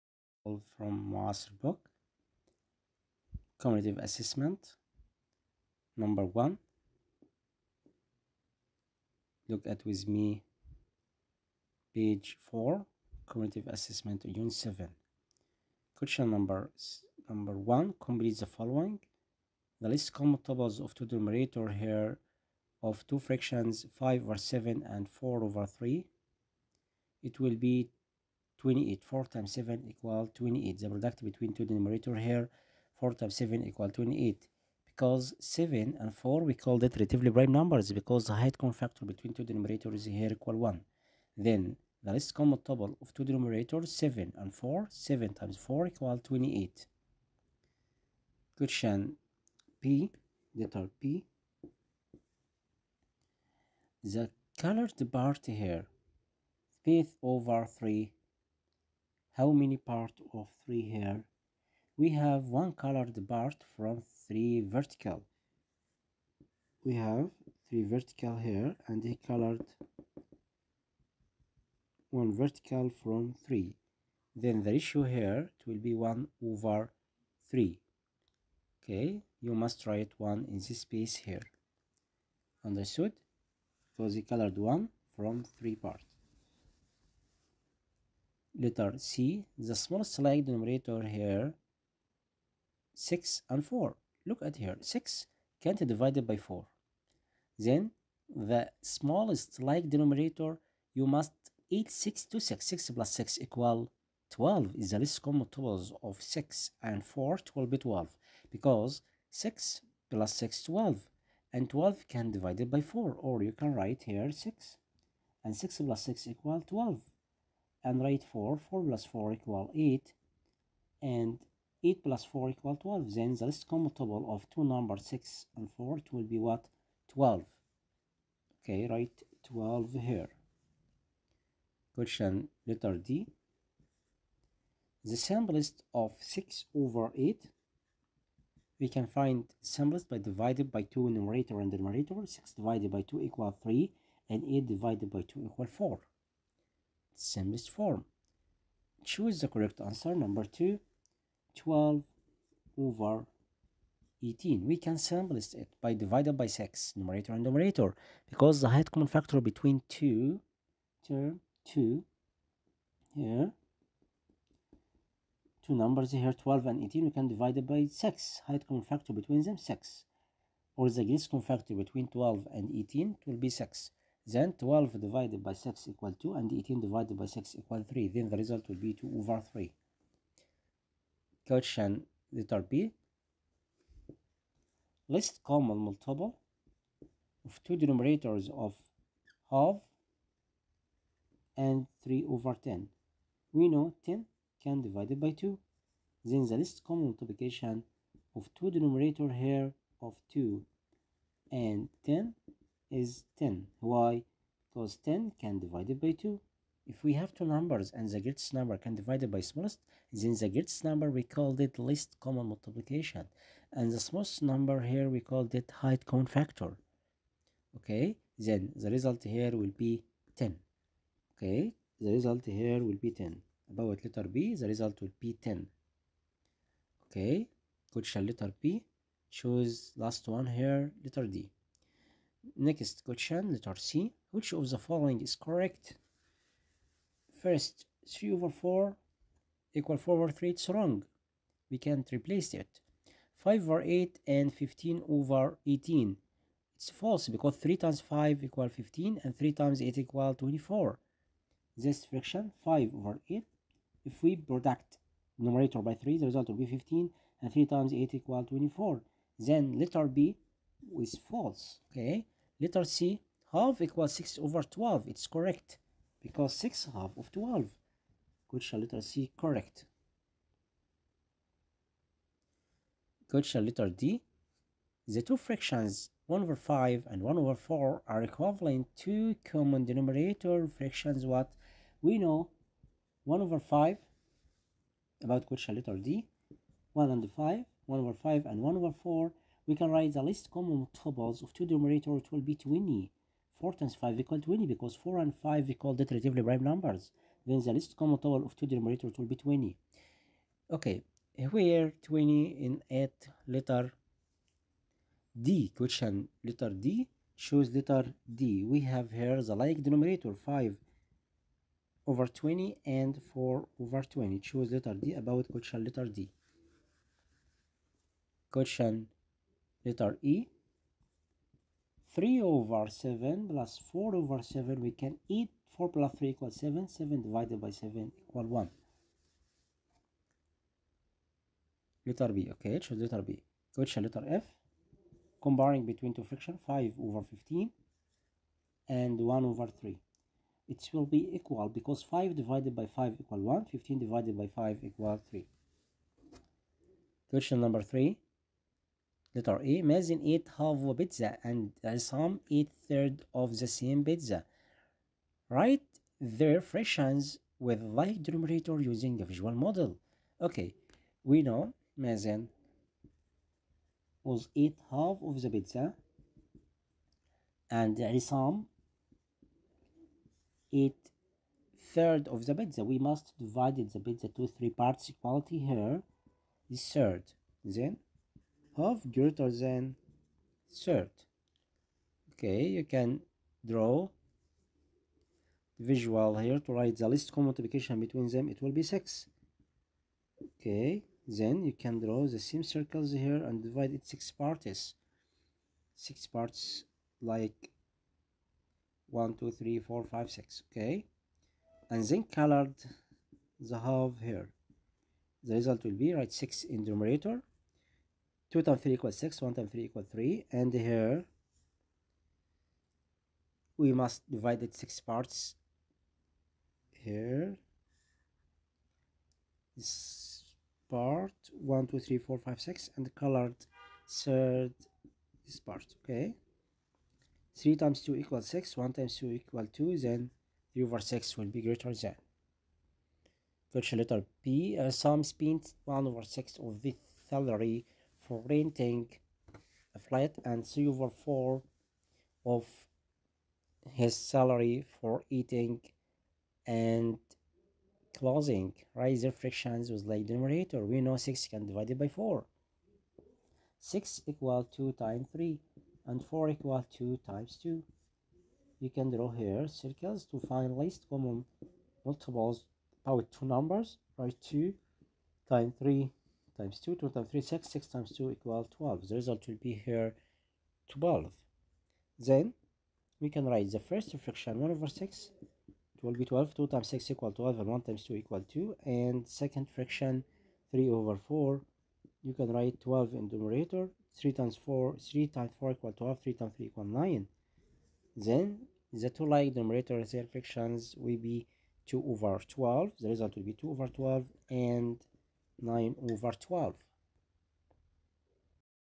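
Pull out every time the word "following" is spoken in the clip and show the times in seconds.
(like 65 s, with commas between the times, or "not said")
18 s, 234 s.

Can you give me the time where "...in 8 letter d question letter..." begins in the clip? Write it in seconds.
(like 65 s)
302 s.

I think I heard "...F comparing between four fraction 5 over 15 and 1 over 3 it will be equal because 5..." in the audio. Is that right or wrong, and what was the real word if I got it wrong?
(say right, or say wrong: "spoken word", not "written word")
wrong: "two", not "four".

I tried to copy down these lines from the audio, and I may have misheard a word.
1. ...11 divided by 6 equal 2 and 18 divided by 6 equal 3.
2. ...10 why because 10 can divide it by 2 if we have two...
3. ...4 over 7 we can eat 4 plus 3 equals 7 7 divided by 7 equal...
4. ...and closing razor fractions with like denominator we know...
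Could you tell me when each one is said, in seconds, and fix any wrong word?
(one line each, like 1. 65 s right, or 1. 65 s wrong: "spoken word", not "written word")
1. 174 s wrong: "12", not "11"
2. 203 s right
3. 323 s right
4. 446 s right.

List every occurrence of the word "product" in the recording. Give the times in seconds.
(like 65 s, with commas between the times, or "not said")
30 s, 254 s.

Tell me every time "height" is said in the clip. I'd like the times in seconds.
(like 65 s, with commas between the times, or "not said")
38 s, 158 s, 168 s, 215 s.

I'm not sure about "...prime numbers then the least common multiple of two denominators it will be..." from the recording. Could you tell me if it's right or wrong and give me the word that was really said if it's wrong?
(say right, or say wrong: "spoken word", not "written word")
right.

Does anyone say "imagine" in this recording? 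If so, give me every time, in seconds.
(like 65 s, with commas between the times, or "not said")
349 s, 361 s.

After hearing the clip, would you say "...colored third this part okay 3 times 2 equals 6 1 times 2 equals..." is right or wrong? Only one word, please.
right.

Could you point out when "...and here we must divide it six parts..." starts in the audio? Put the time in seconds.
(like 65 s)
410 s.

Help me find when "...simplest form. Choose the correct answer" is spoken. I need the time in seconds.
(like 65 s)
147 s.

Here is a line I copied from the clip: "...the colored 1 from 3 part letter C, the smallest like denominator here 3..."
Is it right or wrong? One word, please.
wrong.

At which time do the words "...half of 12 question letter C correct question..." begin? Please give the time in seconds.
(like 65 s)
266 s.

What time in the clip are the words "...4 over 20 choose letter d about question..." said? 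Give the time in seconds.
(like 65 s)
313 s.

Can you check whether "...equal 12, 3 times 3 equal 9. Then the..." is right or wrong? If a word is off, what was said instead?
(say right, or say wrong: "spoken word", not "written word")
right.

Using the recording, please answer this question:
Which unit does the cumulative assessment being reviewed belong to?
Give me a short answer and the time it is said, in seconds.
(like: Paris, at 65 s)
7, at 14 s.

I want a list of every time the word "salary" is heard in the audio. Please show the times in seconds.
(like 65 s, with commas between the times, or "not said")
437 s, 444 s.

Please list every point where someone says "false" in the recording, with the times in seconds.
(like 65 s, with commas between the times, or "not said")
246 s, 261 s.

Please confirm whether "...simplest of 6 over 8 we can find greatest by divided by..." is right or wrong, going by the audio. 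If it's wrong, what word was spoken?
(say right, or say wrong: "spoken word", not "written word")
wrong: "simplest", not "greatest".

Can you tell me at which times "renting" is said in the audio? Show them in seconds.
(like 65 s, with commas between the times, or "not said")
438 s.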